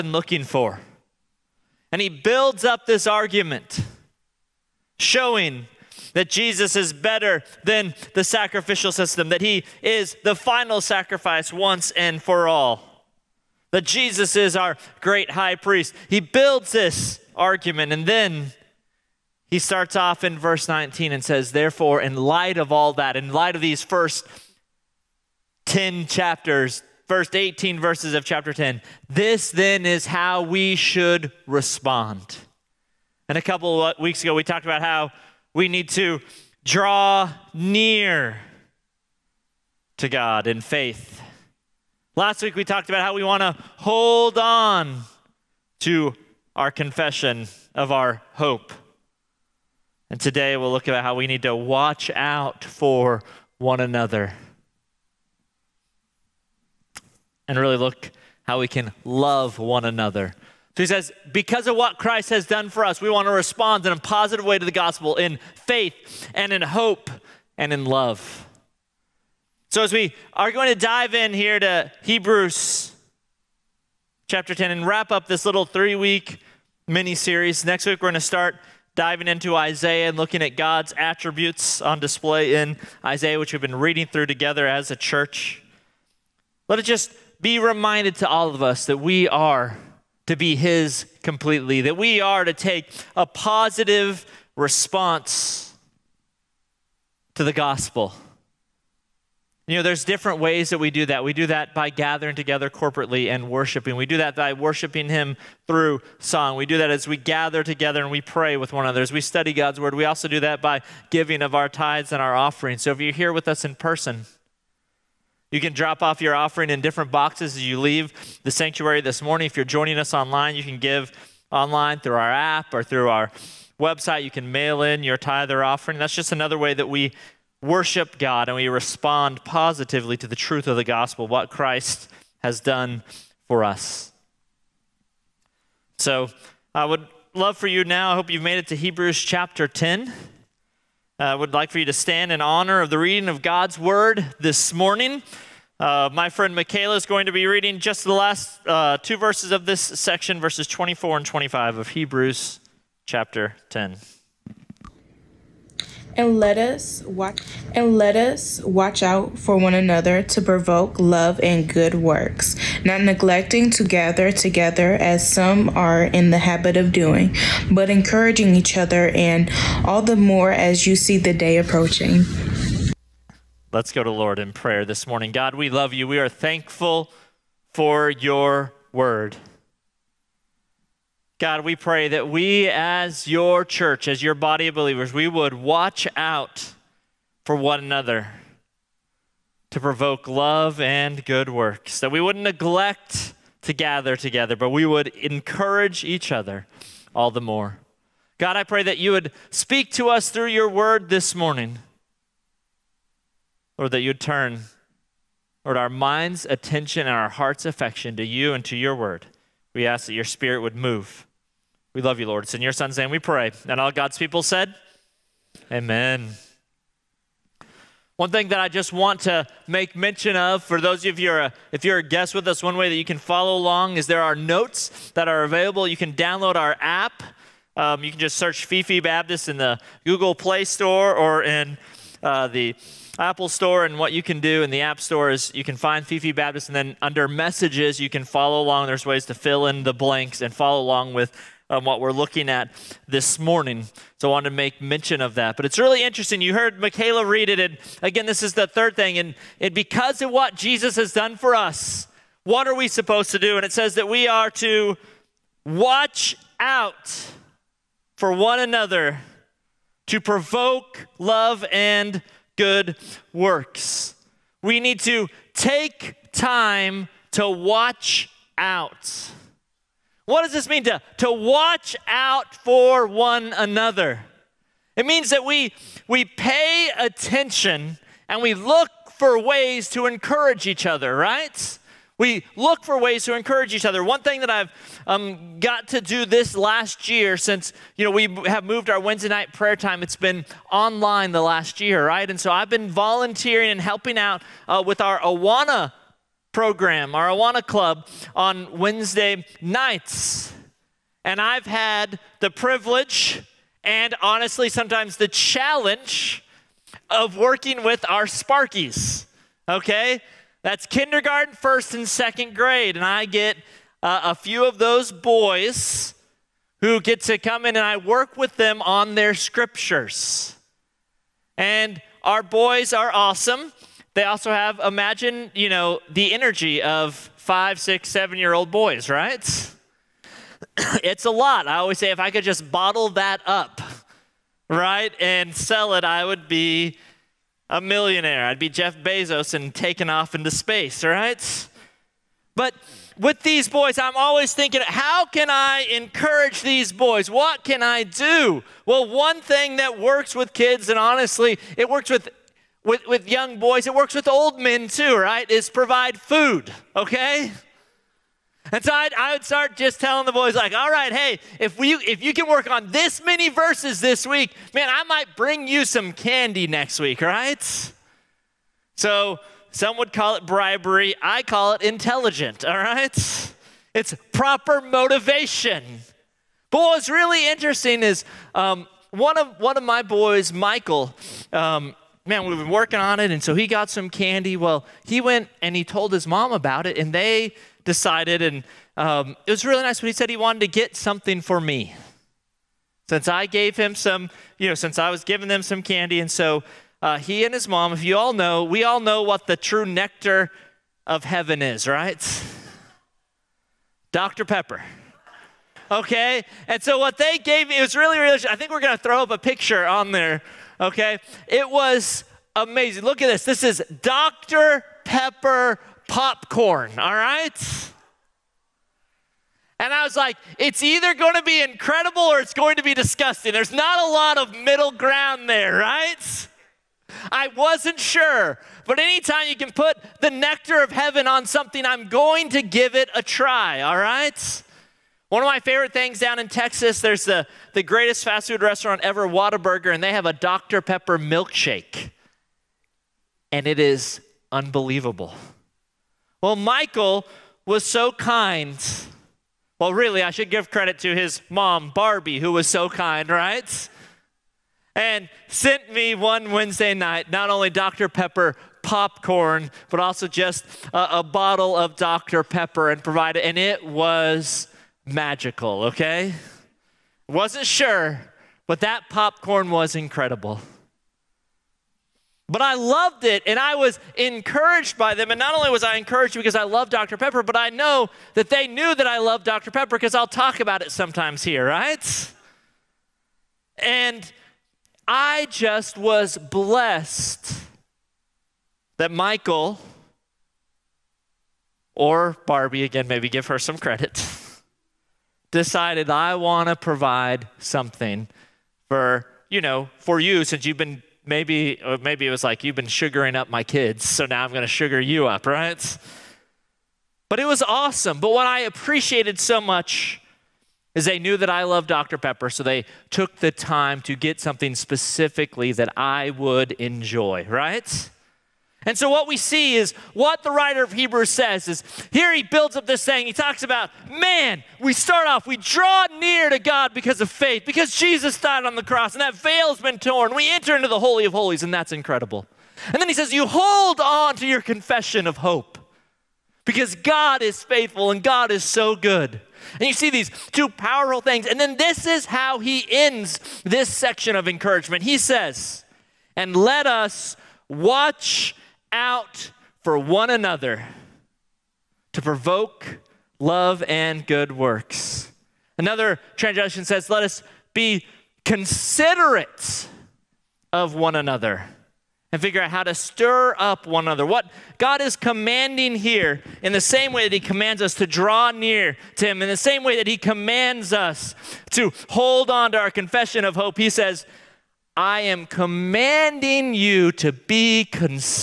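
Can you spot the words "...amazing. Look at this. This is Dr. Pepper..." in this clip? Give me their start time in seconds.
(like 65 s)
412 s.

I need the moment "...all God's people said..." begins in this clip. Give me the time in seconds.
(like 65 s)
213 s.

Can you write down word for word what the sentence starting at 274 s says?
It means that we, we pay attention and we look for ways to encourage each other, right?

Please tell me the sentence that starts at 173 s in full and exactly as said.
Let's go to Lord in prayer this morning.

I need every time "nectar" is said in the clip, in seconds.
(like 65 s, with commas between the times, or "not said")
399 s, 430 s.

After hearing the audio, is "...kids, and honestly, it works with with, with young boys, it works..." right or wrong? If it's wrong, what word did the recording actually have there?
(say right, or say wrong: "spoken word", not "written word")
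right.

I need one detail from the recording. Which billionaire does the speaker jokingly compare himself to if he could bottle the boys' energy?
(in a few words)
Jeff Bezos.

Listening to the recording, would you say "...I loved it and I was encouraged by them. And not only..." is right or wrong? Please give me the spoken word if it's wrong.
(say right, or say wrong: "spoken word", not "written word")
right.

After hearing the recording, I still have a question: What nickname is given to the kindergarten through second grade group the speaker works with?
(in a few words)
Sparkies.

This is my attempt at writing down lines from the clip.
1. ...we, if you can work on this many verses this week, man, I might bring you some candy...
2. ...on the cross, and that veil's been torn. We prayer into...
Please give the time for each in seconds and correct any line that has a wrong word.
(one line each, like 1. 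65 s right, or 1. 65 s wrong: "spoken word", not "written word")
1. 361 s right
2. 528 s wrong: "enter", not "prayer".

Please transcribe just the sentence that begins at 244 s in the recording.
So I want to make mention of that.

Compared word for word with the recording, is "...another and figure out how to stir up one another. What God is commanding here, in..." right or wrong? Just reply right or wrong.
right.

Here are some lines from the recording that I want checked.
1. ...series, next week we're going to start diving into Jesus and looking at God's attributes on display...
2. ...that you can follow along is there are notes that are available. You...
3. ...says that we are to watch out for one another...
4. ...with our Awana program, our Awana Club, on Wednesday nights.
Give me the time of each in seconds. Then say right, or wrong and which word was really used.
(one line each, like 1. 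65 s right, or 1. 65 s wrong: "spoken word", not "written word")
1. 77 s wrong: "Isaiah", not "Jesus"
2. 222 s right
3. 253 s right
4. 294 s right.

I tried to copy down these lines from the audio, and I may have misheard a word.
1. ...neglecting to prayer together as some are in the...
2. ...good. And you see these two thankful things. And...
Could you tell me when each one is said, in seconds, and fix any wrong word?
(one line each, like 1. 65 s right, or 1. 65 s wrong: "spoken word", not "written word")
1. 163 s wrong: "gather", not "prayer"
2. 538 s wrong: "powerful", not "thankful".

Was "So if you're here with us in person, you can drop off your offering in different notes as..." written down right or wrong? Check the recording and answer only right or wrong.
wrong.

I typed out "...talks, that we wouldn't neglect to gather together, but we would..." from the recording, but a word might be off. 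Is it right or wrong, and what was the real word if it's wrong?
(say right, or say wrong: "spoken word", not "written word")
wrong: "works", not "talks".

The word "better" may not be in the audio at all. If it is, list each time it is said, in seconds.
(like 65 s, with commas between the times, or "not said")
6 s.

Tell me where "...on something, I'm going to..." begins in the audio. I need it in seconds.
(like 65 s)
431 s.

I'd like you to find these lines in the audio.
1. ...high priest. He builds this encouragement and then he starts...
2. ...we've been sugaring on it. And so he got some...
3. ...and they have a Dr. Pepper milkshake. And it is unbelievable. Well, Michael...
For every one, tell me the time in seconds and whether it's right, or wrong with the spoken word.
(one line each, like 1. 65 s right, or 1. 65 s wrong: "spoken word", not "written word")
1. 15 s wrong: "argument", not "encouragement"
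2. 382 s wrong: "working", not "sugaring"
3. 439 s right.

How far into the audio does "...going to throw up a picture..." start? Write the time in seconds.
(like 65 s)
408 s.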